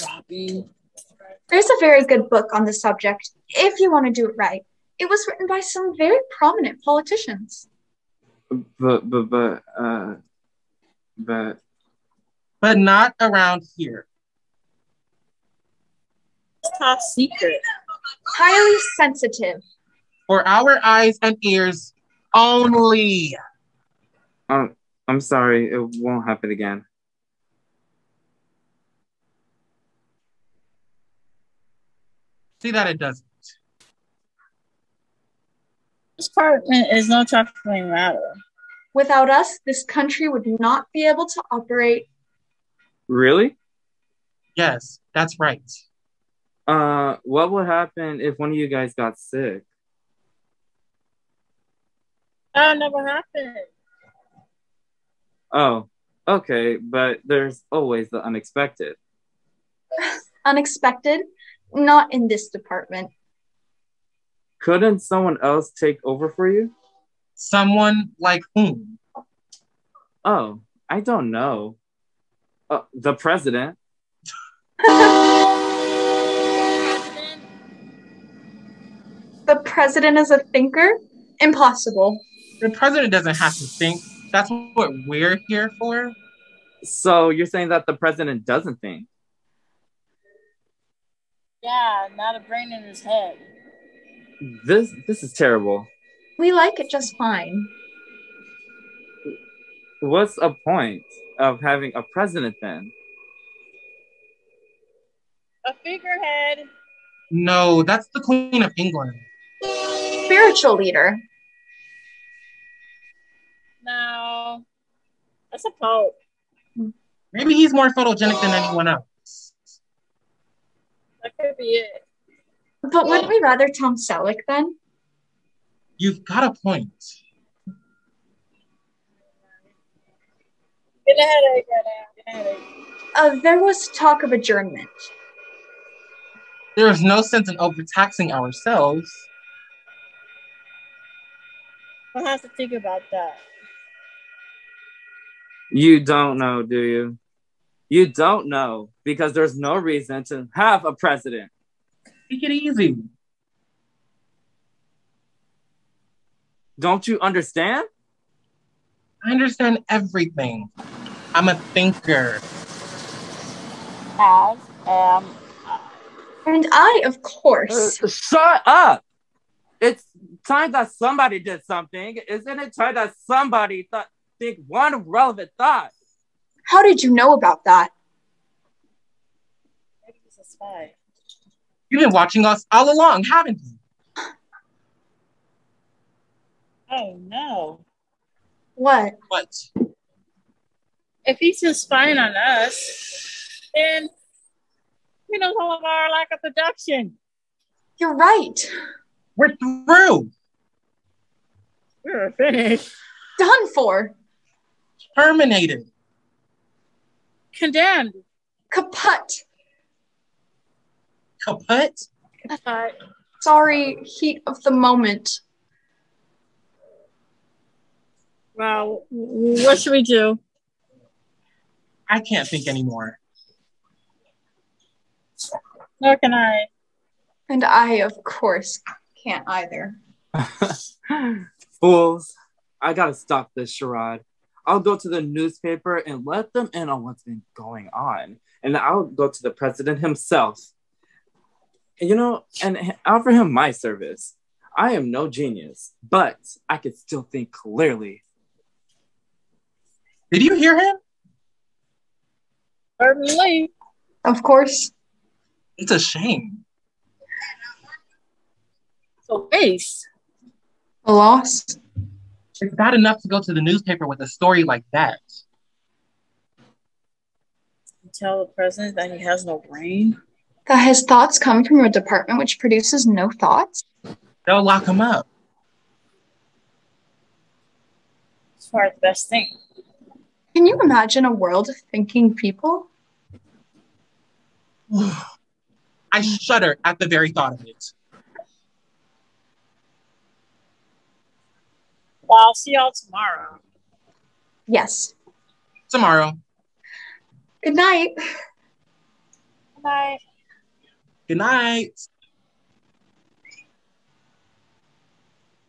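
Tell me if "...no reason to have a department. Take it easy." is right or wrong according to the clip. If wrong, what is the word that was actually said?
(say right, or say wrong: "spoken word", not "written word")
wrong: "president", not "department".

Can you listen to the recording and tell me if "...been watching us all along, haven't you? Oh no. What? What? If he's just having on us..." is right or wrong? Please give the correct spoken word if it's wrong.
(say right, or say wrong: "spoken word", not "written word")
wrong: "spying", not "having".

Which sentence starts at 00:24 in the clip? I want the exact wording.
Um, I'm sorry, it won't happen again.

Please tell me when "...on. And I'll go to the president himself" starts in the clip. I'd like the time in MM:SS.
03:57.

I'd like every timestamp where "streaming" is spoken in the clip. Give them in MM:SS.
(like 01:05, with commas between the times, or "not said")
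not said.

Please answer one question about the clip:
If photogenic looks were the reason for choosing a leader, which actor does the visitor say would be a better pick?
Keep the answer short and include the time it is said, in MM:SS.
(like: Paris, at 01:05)
Tom Selleck, at 02:03.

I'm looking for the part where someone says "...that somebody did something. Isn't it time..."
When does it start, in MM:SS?
02:50.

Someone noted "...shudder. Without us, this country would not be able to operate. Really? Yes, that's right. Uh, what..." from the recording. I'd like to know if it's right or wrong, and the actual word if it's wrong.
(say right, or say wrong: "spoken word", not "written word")
wrong: "matter", not "shudder".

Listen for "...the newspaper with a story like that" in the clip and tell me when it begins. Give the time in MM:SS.
04:23.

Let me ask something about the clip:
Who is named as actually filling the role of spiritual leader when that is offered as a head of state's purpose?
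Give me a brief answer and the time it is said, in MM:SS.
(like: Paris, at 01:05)
A pope, at 01:55.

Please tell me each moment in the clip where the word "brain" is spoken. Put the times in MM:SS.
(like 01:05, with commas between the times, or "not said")
01:32, 04:29.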